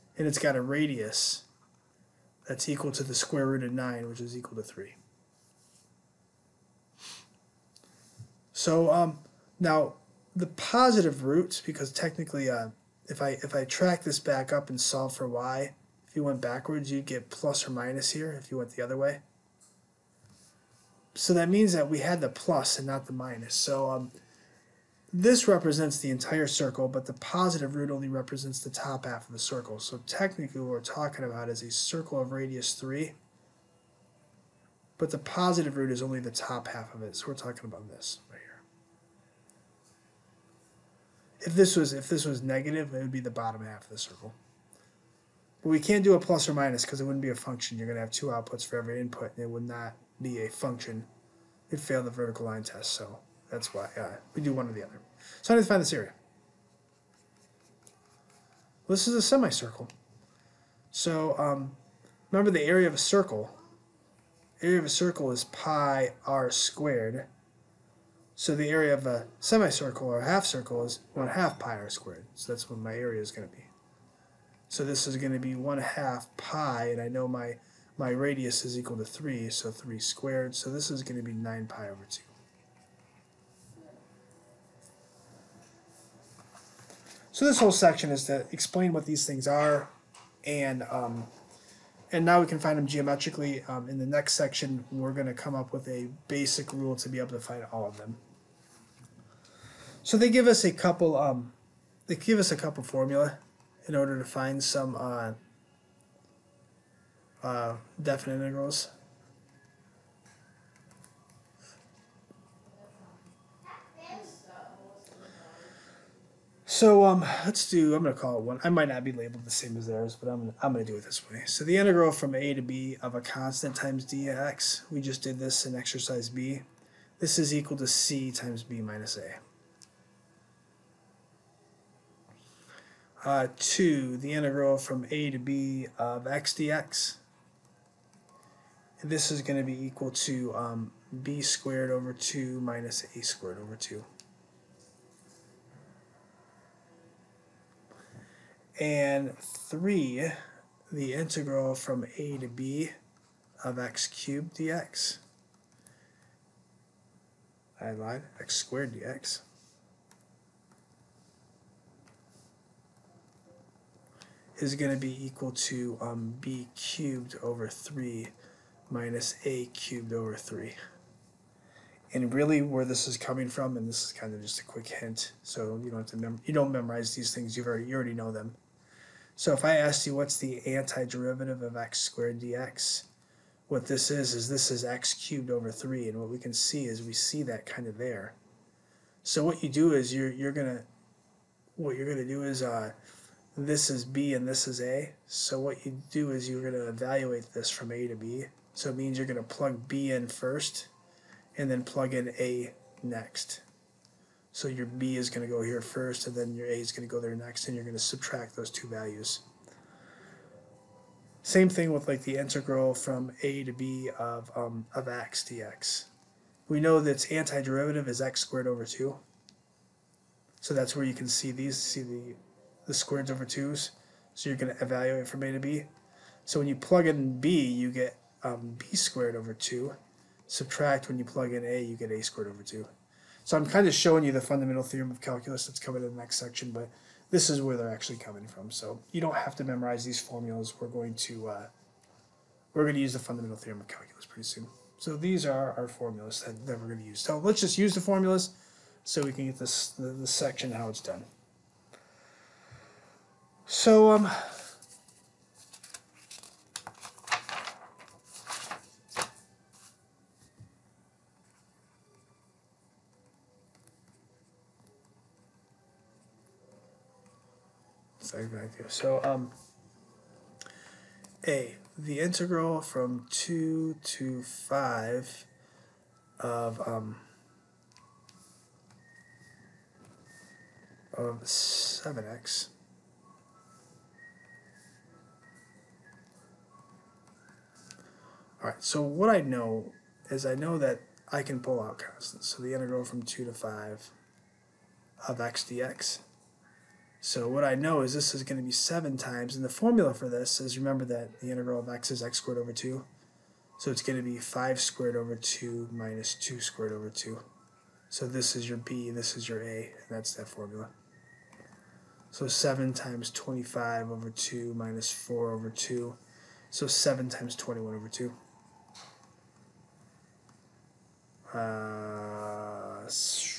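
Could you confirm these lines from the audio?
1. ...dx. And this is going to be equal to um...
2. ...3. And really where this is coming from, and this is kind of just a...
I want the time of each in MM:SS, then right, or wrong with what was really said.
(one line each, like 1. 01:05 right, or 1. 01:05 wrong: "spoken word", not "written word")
1. 02:16 right
2. 02:50 right.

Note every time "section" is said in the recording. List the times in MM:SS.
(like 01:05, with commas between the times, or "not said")
01:27, 01:34, 03:56, 04:10.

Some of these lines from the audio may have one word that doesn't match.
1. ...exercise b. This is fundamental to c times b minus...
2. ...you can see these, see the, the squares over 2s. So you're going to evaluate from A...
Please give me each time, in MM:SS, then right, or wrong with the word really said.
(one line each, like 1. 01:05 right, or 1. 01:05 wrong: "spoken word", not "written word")
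1. 02:05 wrong: "equal", not "fundamental"
2. 03:41 right.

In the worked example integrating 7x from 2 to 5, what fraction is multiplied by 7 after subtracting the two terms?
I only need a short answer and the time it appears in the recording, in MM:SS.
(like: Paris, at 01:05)
21 over 2, at 05:17.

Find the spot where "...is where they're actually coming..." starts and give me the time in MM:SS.
03:57.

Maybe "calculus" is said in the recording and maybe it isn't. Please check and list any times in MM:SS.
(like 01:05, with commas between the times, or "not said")
03:55, 04:03.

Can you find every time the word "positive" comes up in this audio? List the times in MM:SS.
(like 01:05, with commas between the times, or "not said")
00:10, 00:27, 00:35.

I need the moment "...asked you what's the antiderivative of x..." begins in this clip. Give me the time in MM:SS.
02:59.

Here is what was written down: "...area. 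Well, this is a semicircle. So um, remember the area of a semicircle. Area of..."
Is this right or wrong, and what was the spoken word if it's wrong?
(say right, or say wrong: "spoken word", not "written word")
wrong: "circle", not "semicircle".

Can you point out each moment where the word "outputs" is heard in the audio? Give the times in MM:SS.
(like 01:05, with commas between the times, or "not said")
00:48.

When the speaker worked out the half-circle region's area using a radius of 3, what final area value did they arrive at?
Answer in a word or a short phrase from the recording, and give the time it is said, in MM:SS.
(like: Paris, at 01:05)
9 pi over 2, at 01:21.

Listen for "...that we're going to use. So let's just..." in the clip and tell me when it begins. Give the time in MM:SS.
04:06.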